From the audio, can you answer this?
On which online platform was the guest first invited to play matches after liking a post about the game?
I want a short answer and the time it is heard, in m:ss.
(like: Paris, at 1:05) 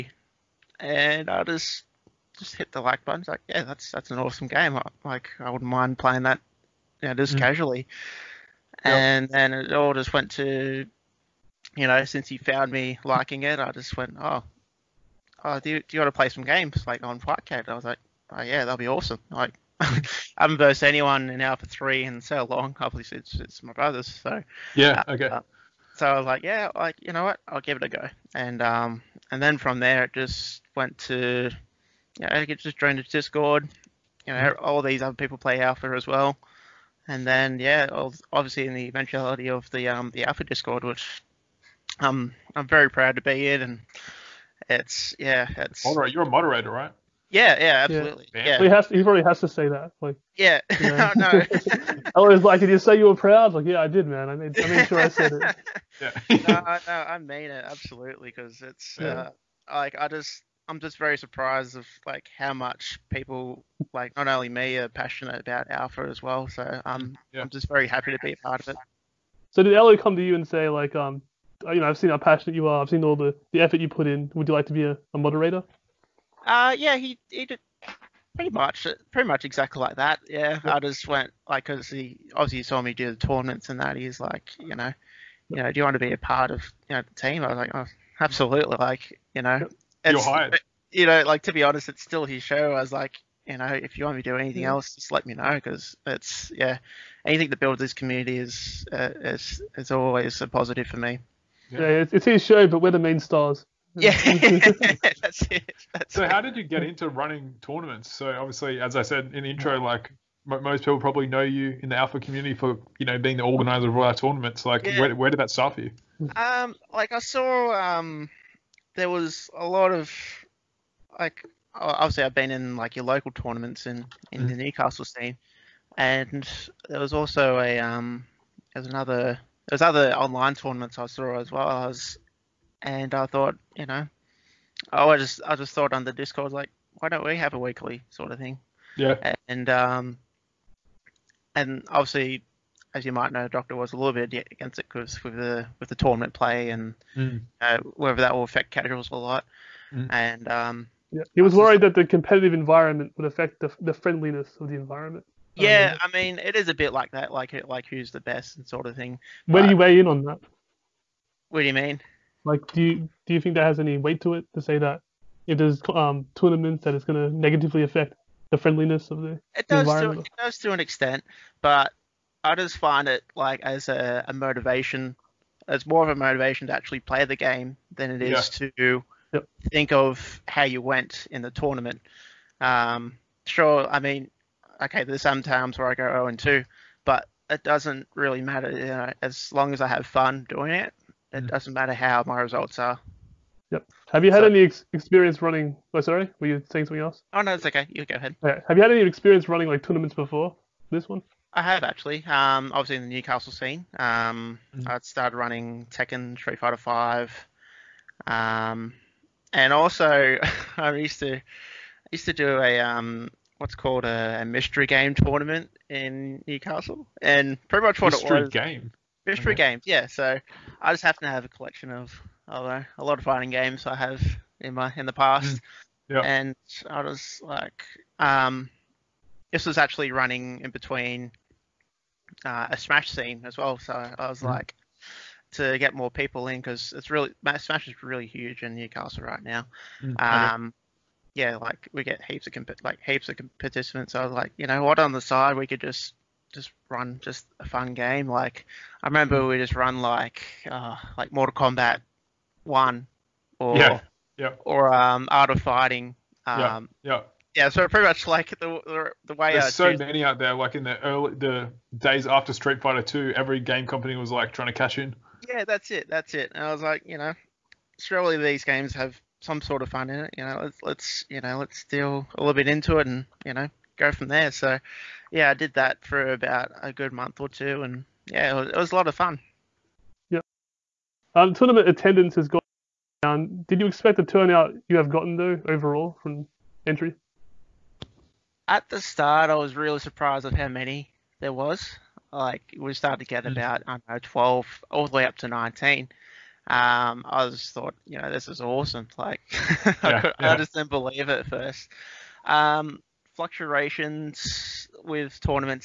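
Fightcade, at 0:17.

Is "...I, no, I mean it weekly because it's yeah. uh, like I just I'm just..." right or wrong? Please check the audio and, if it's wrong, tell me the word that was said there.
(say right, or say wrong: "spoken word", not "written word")
wrong: "absolutely", not "weekly".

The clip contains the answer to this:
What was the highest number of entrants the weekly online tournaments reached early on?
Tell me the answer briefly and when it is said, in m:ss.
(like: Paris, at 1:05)
19, at 4:55.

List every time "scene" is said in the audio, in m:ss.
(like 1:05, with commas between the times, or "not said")
2:05, 3:23, 3:53.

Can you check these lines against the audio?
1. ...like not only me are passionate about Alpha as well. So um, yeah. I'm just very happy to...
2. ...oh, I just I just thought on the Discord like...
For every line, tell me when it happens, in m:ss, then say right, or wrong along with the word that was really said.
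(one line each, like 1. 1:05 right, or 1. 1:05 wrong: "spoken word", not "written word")
1. 1:03 right
2. 2:14 right.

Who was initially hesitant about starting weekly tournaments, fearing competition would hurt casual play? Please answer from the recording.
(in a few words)
Doctor.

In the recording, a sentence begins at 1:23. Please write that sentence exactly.
He's like, you know, you know, do you want to be a part of you know the team?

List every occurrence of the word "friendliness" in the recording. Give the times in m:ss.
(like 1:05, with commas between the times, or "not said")
2:33, 2:48.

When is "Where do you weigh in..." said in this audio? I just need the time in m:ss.
2:39.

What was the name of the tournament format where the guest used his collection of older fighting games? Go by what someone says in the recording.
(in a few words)
mystery game tournament.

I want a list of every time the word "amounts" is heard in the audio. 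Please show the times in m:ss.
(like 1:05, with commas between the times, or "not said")
not said.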